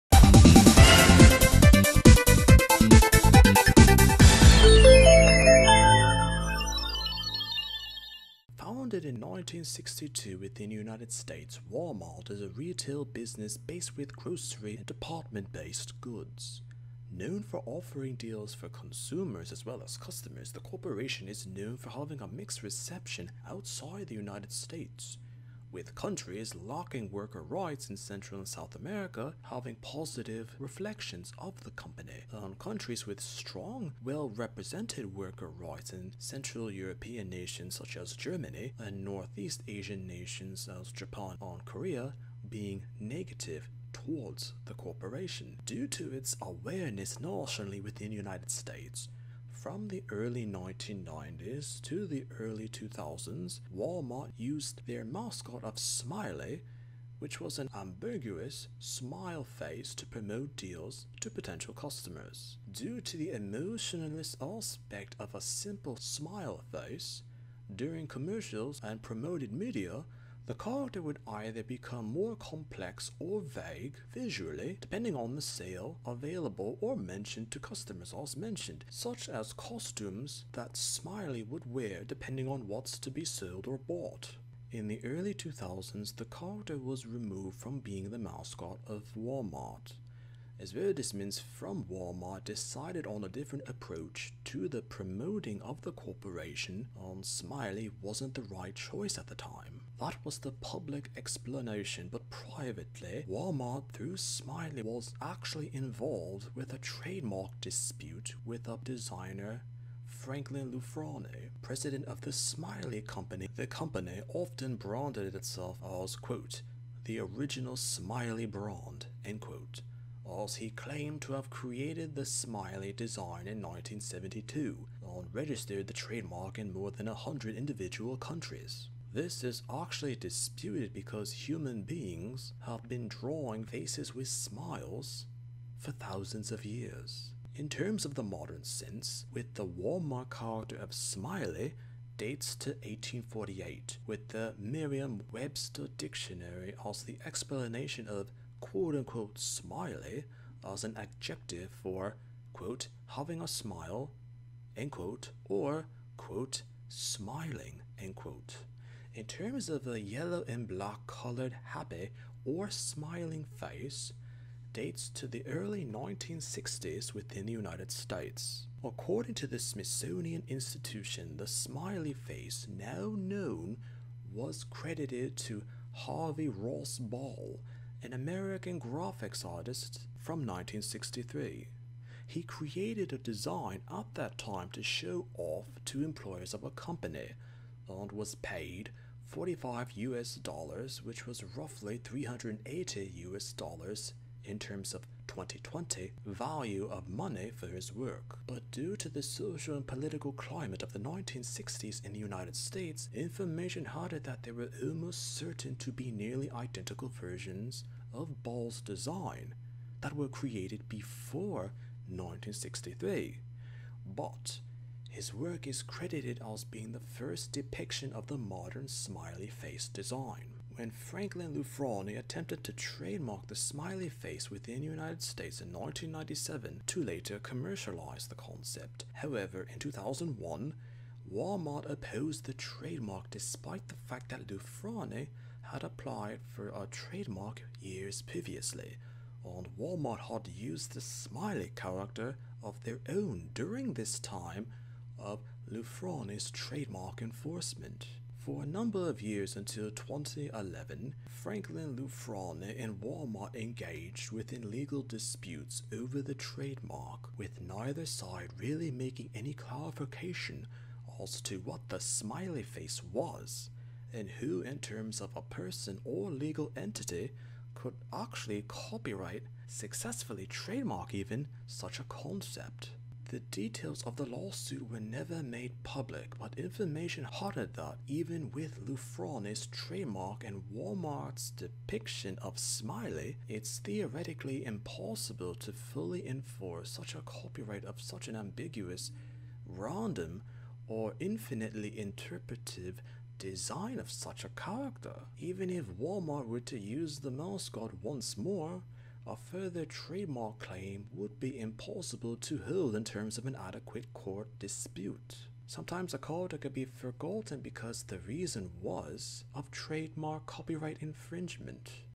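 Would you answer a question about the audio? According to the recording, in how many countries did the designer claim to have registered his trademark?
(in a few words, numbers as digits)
more than 100.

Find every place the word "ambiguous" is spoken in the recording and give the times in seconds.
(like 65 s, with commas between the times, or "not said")
57 s, 288 s.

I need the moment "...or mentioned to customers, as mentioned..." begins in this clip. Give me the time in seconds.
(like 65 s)
76 s.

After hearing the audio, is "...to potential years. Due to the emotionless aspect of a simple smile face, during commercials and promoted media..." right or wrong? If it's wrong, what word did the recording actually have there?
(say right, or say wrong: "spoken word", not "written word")
wrong: "customers", not "years".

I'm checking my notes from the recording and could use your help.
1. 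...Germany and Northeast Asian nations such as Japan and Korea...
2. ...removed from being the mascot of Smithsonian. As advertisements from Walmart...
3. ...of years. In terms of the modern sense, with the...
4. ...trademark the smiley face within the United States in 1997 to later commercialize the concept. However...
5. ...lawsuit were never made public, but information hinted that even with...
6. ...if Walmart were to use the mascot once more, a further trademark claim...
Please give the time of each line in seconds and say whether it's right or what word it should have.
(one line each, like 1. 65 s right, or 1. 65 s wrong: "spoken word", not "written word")
1. 38 s right
2. 87 s wrong: "Walmart", not "Smithsonian"
3. 136 s right
4. 222 s right
5. 274 s right
6. 295 s right.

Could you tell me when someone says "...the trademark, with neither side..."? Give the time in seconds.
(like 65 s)
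256 s.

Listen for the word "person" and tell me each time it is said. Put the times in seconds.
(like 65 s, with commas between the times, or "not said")
265 s.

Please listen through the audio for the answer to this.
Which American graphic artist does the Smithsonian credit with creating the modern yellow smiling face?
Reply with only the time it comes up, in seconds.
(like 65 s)
175 s.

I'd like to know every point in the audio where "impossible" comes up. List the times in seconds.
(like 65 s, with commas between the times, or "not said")
284 s, 301 s.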